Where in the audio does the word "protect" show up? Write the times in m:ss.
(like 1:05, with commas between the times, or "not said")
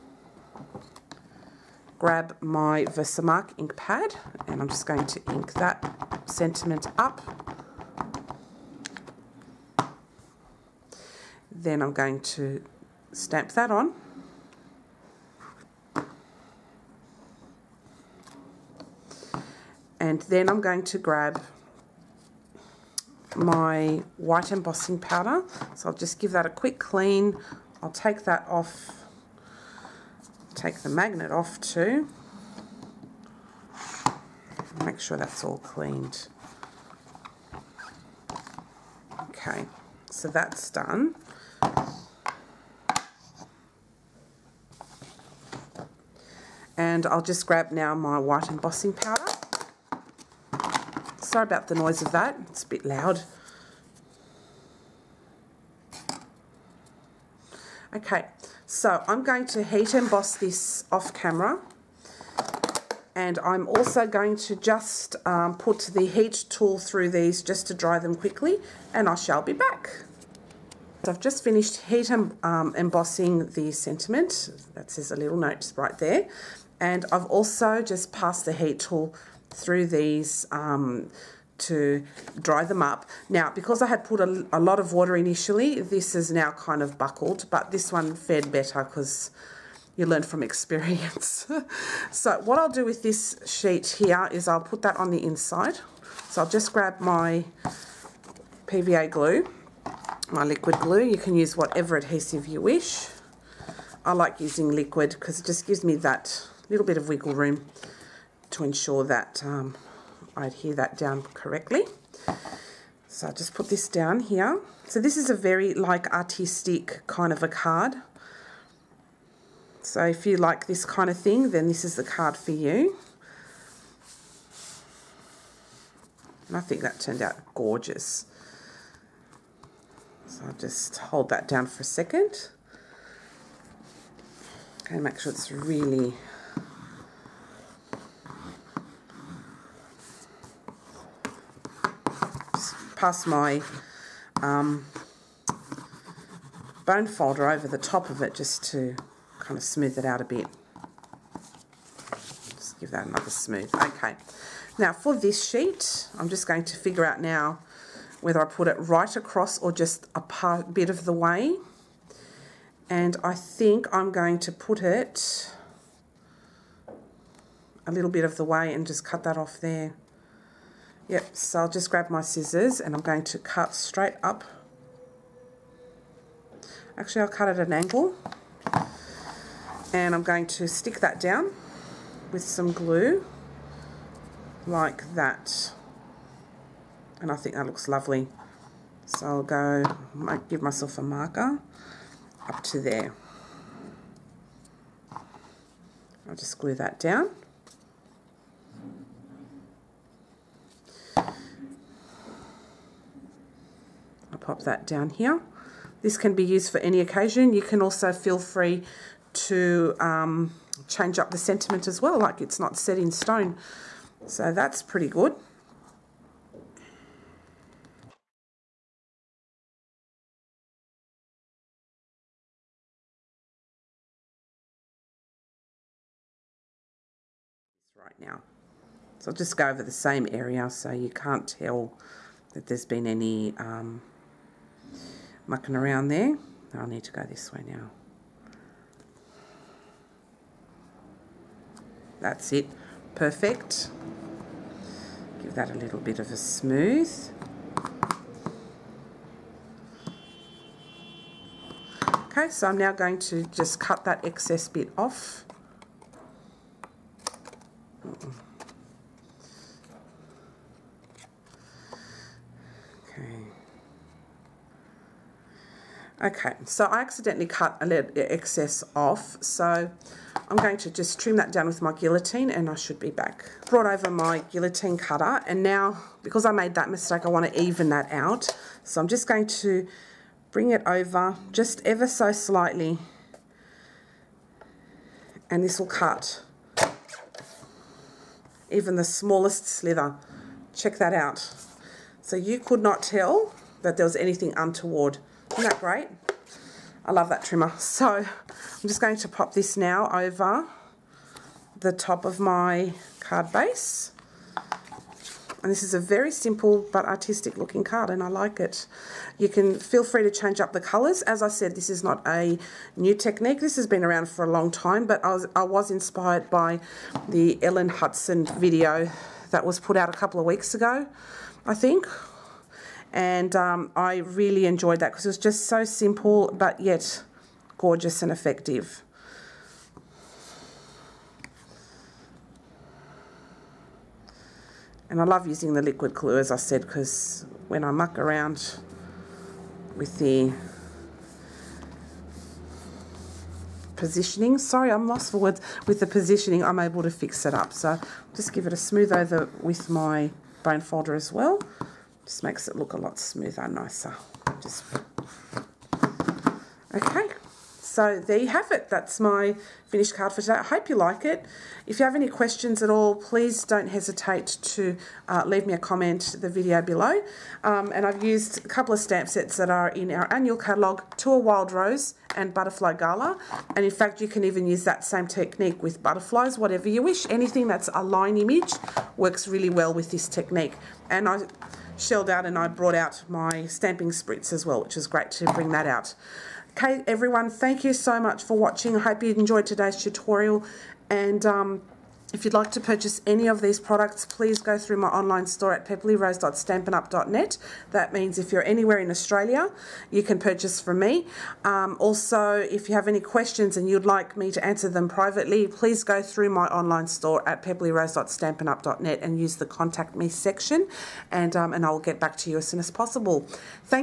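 not said.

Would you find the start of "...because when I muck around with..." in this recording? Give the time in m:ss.
5:36.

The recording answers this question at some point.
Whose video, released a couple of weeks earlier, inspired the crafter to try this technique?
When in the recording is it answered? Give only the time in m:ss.
5:17.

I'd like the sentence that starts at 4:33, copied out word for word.
Brought over my guillotine cutter and now, because I made that mistake, I want to even that out.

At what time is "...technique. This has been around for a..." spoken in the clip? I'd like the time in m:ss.
5:13.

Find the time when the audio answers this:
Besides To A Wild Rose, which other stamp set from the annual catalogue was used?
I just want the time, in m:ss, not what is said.
6:12.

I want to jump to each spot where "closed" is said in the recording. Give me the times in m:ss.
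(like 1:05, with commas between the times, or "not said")
not said.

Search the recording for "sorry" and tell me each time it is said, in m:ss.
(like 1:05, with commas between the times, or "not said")
0:51, 5:44.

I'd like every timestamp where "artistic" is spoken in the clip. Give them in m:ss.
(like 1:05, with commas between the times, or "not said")
1:56, 5:07.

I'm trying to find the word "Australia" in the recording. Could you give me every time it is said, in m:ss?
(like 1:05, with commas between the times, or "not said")
6:39.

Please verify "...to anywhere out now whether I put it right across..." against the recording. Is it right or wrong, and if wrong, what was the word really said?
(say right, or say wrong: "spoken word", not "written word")
wrong: "figure", not "anywhere".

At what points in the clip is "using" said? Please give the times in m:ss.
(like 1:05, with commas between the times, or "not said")
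1:44, 5:35.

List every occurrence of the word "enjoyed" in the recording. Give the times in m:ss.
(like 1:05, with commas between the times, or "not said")
5:24, 6:29.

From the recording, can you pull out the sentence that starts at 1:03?
And I'm also going to just um, put the heat tool through these just to dry them quickly.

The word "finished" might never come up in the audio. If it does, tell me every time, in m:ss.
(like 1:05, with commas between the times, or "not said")
1:11, 5:59.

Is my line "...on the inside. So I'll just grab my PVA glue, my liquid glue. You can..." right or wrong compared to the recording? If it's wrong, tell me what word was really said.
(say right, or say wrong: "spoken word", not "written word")
right.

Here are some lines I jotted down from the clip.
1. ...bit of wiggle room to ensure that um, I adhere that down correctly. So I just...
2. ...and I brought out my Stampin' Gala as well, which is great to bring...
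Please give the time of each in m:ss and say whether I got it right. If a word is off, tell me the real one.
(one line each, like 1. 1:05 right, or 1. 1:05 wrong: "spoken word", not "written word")
1. 1:46 right
2. 6:22 wrong: "Spritz", not "Gala".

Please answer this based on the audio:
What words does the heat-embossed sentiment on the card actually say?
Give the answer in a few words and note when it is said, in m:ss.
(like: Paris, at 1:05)
A little note, at 1:15.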